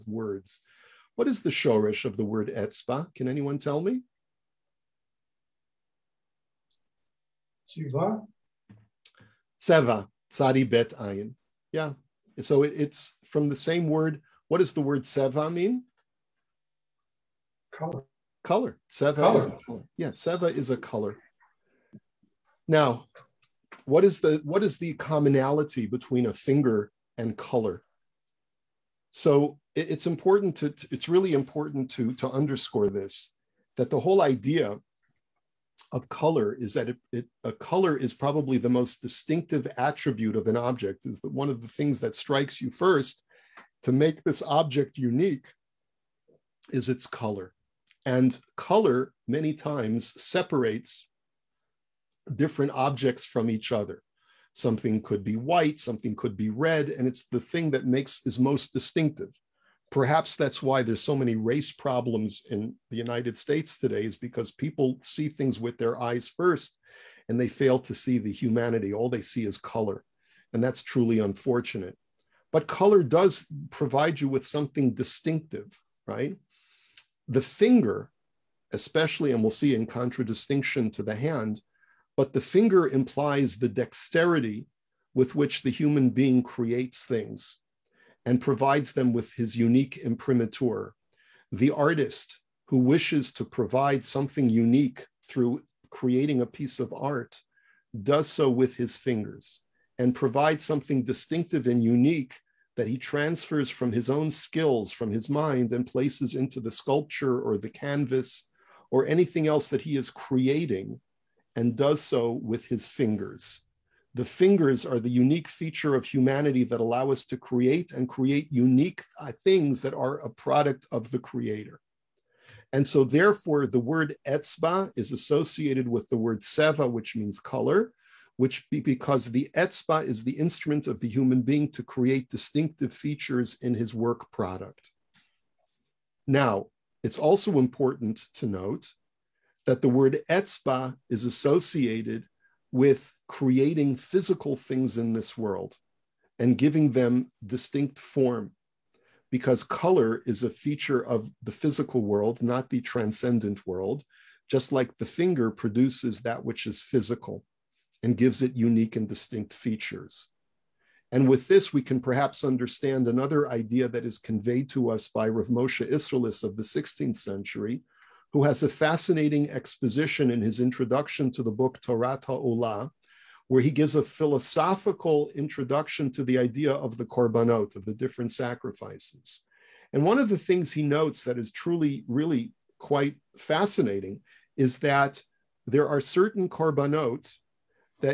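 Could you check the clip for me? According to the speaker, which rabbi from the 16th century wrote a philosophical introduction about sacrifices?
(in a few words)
Rav Moshe Isserles.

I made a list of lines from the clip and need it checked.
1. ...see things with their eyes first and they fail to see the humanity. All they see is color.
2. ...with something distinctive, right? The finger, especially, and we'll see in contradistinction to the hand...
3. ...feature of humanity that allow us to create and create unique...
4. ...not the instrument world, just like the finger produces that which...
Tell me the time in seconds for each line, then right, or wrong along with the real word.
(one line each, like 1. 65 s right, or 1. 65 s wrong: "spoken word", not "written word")
1. 65 s right
2. 74 s right
3. 115 s right
4. 152 s wrong: "transcendent", not "instrument".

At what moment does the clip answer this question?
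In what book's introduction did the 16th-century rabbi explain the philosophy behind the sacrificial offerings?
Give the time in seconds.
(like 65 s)
171 s.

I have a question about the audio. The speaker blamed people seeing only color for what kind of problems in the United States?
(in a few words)
Race problems.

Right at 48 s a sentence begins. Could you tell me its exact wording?
And color many times separates different objects from each other.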